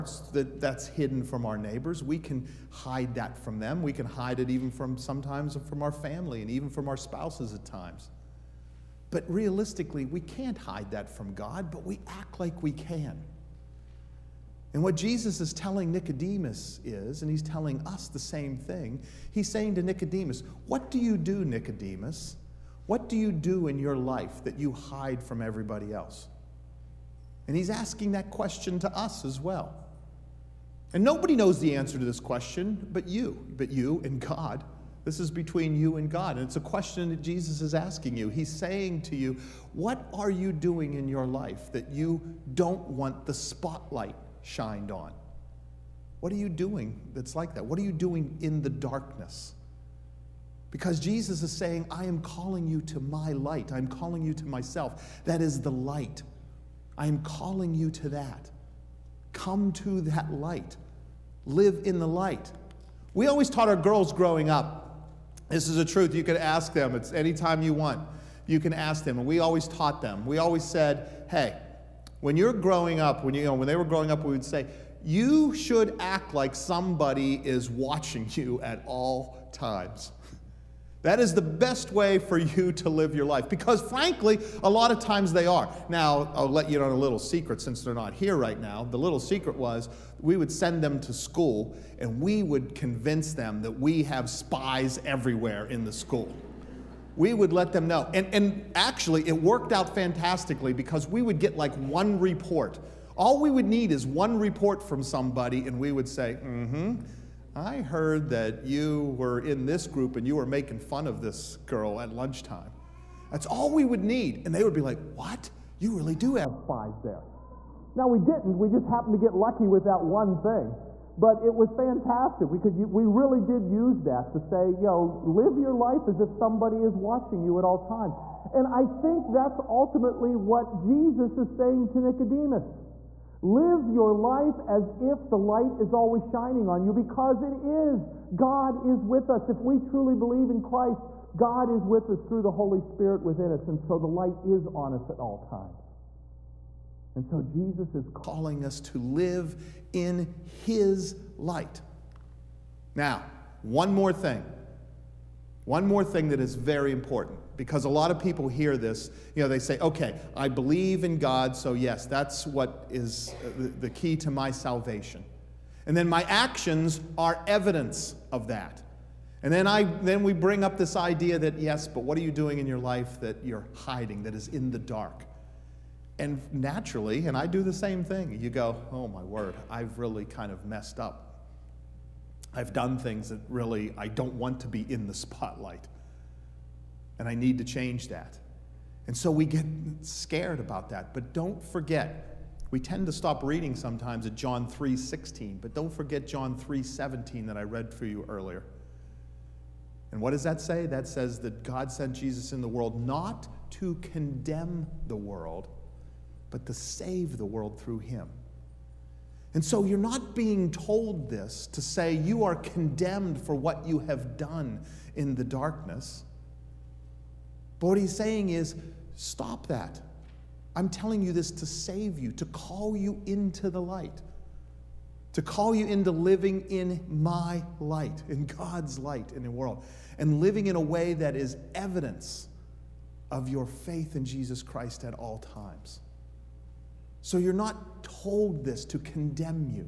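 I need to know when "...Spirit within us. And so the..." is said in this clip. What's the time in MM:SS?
02:22.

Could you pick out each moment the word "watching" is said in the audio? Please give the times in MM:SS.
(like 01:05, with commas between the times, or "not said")
01:17, 02:06.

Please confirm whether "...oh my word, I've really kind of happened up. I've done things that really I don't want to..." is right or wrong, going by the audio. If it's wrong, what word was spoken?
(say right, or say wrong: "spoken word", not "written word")
wrong: "messed", not "happened".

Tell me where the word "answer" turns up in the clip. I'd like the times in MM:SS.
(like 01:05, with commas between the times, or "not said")
00:31.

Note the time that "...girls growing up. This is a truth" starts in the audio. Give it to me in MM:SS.
01:03.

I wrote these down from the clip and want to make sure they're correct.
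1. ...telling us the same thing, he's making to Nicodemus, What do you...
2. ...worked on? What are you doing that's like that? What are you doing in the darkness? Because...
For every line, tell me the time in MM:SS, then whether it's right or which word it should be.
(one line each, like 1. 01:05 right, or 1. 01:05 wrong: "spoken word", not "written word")
1. 00:17 wrong: "saying", not "making"
2. 00:44 wrong: "shined", not "worked".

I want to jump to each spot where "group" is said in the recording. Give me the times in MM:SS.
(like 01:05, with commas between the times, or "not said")
01:49.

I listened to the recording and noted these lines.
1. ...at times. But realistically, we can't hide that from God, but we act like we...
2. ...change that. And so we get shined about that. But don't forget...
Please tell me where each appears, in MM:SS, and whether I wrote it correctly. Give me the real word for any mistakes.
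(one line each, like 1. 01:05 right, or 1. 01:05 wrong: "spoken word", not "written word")
1. 00:07 right
2. 03:07 wrong: "scared", not "shined".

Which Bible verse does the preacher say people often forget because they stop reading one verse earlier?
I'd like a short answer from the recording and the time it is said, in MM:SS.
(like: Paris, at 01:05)
John 3:17, at 03:16.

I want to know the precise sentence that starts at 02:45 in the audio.
And then my actions are evidence of that.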